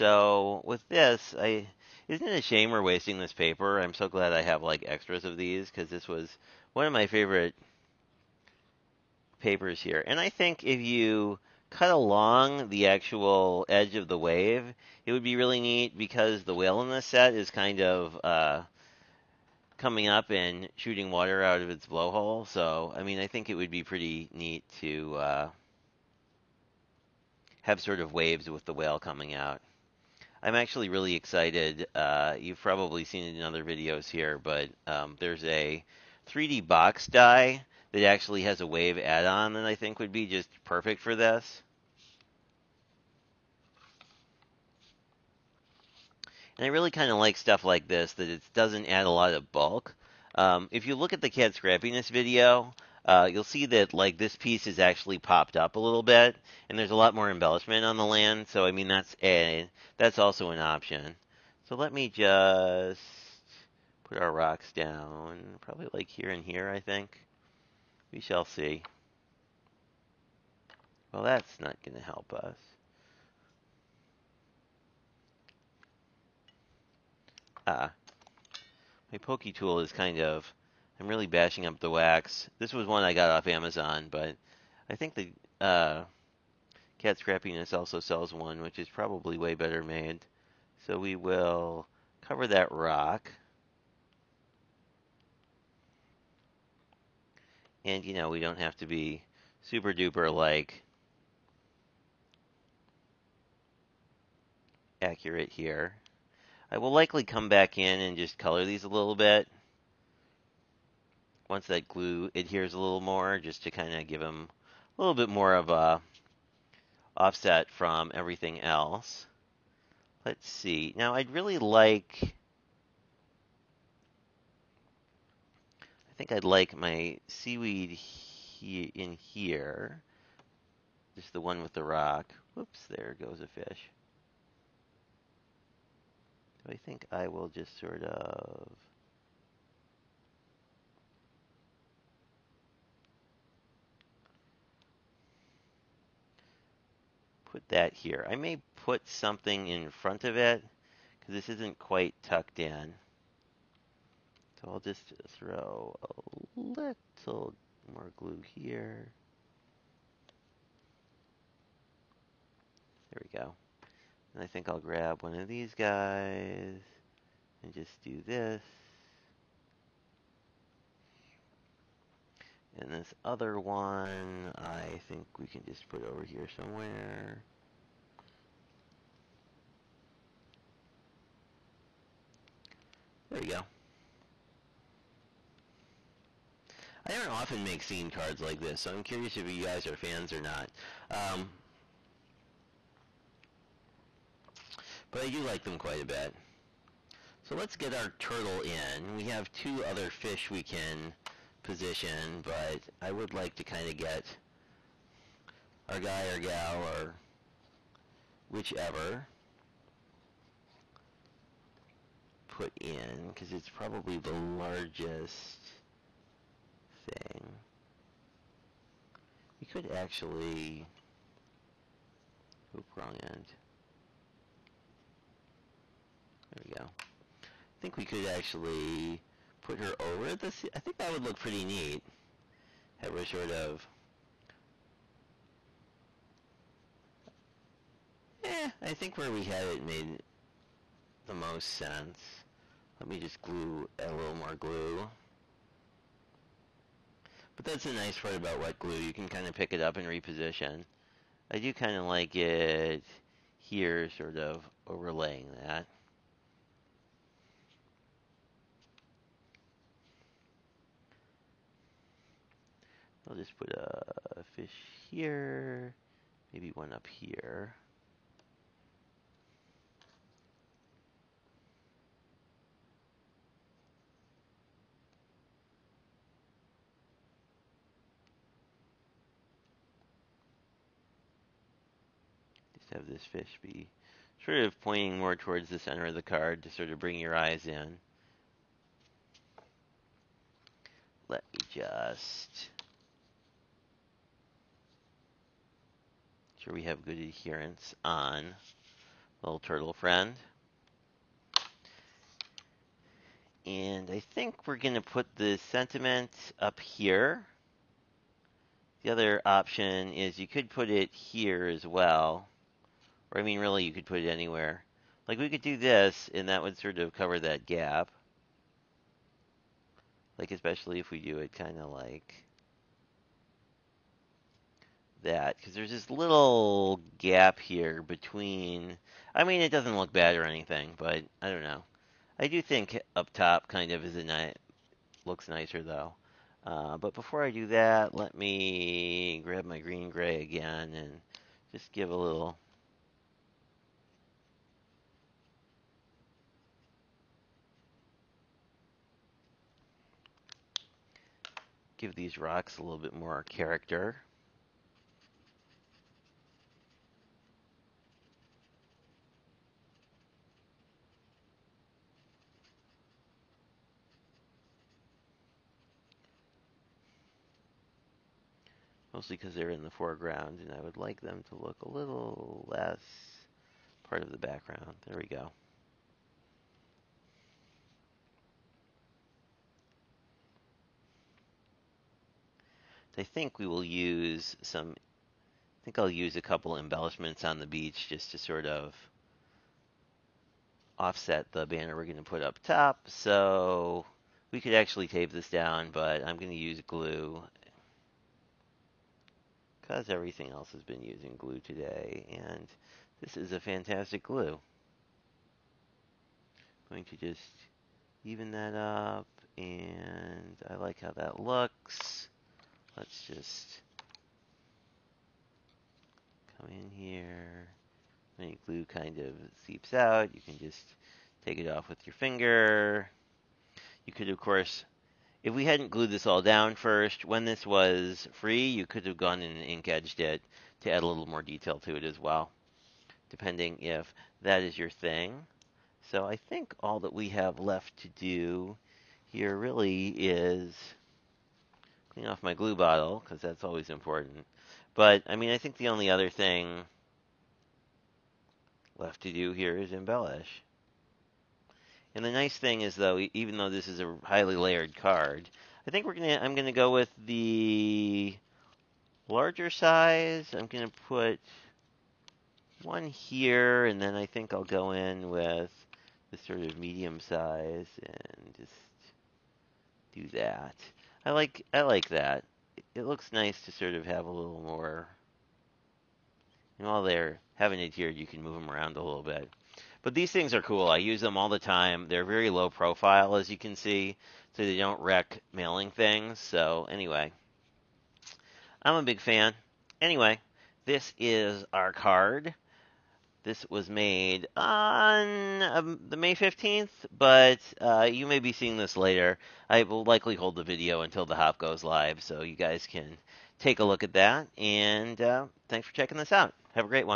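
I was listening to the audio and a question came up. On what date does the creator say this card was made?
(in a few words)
May 15th.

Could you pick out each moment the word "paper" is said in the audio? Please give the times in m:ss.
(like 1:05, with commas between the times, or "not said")
0:03, 0:09.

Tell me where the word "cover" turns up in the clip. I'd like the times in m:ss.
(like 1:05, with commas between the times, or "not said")
1:32, 5:17.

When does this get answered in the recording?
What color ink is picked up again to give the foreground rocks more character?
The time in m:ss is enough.
5:39.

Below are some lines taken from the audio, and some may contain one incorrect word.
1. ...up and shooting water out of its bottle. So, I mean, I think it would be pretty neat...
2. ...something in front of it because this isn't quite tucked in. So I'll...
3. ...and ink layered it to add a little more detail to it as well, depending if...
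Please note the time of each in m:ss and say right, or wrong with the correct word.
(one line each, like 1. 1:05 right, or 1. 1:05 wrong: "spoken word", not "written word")
1. 0:20 wrong: "blowhole", not "bottle"
2. 2:29 right
3. 7:09 wrong: "edged", not "layered".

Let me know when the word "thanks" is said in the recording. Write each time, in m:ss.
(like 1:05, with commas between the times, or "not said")
8:25.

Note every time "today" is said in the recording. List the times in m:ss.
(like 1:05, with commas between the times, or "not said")
6:41.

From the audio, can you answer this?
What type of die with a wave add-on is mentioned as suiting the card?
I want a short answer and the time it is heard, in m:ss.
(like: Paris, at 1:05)
3D box die, at 0:36.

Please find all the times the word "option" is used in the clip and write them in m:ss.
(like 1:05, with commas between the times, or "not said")
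1:00, 5:09.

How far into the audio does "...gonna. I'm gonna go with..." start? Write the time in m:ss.
7:36.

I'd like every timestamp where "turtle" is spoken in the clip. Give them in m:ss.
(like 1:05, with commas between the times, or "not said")
3:18, 4:59.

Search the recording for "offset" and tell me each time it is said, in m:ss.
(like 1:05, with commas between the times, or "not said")
1:57, 6:30.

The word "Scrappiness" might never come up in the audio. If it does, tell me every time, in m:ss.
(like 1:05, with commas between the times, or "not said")
0:51, 1:27.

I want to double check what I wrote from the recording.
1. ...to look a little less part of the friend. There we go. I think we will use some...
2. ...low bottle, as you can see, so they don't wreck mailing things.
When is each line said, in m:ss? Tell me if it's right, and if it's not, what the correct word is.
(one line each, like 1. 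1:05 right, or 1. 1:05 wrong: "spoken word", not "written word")
1. 6:11 wrong: "background", not "friend"
2. 8:02 wrong: "profile", not "bottle".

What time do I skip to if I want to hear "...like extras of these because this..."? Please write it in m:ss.
0:04.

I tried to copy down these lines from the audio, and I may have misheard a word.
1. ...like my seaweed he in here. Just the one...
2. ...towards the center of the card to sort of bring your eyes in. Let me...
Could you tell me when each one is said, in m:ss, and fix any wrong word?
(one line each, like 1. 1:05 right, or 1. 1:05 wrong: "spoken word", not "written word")
1. 2:06 right
2. 4:45 right.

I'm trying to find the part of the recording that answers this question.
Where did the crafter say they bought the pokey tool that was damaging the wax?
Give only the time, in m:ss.
1:23.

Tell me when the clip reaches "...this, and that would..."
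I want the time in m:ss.
5:15.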